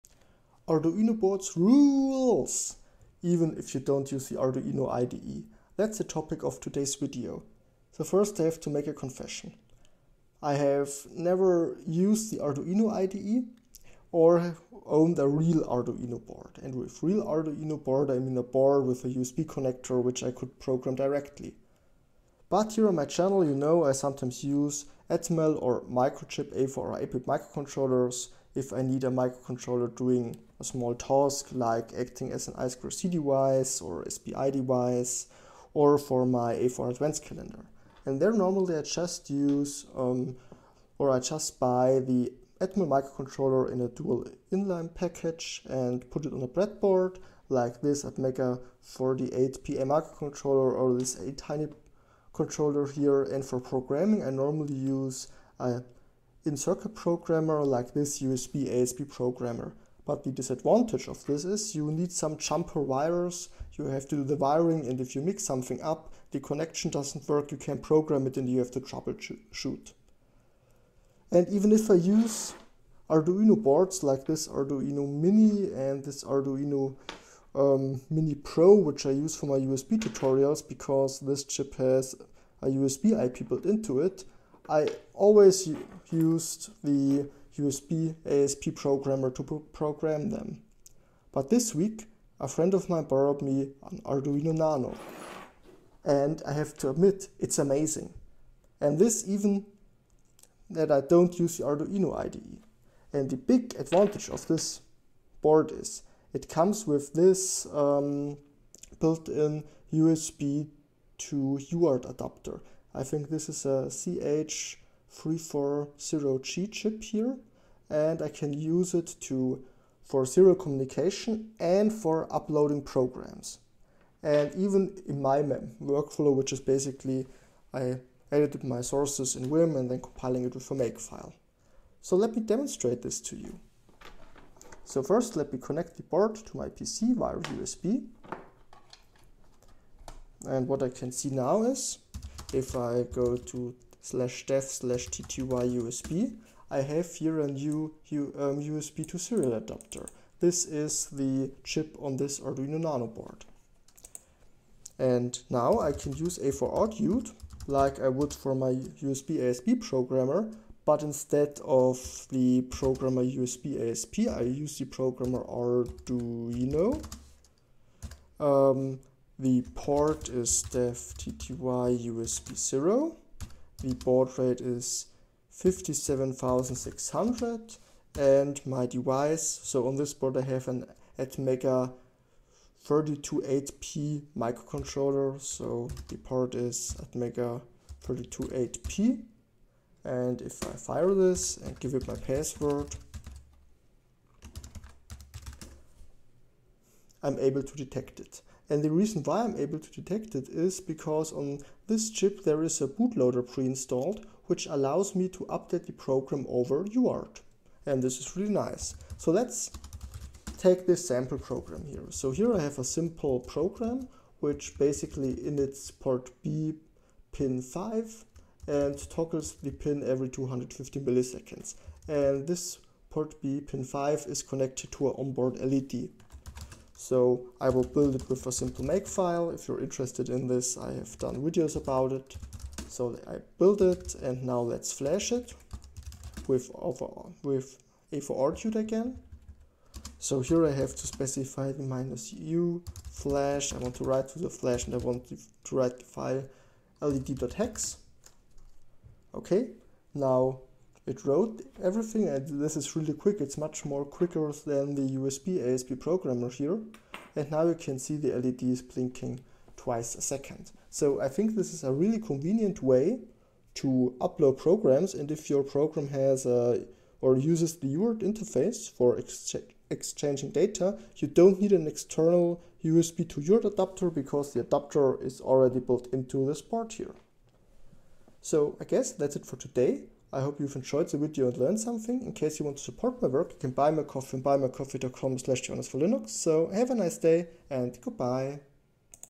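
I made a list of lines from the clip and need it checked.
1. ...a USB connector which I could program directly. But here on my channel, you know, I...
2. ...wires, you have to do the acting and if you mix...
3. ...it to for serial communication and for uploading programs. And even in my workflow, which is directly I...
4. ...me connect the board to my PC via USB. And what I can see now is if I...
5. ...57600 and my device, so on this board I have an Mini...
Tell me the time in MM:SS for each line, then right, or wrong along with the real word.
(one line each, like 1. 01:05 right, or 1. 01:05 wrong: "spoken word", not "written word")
1. 00:19 right
2. 01:02 wrong: "wiring", not "acting"
3. 01:58 wrong: "basically", not "directly"
4. 02:15 right
5. 02:55 wrong: "Atmega", not "Mini".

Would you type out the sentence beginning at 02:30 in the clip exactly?
This is the chip on this Arduino Nano board.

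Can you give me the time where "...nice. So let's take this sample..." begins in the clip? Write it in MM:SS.
03:28.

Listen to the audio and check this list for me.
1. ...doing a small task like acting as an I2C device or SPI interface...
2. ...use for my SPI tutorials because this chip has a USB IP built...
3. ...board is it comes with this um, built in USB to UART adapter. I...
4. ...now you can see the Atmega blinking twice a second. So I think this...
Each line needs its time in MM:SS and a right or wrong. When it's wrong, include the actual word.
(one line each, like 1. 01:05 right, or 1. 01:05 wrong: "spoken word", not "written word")
1. 00:29 wrong: "device", not "interface"
2. 01:19 wrong: "USB", not "SPI"
3. 01:45 right
4. 04:17 wrong: "LEDs", not "Atmega".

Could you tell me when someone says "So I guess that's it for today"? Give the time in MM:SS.
04:38.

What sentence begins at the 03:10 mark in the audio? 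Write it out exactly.
And if I fire this and give it my password, I'm able to detect it.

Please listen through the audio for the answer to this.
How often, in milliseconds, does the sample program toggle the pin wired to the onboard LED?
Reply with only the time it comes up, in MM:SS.
03:40.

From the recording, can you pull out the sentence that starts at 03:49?
If you're interested in this, I have done videos about it.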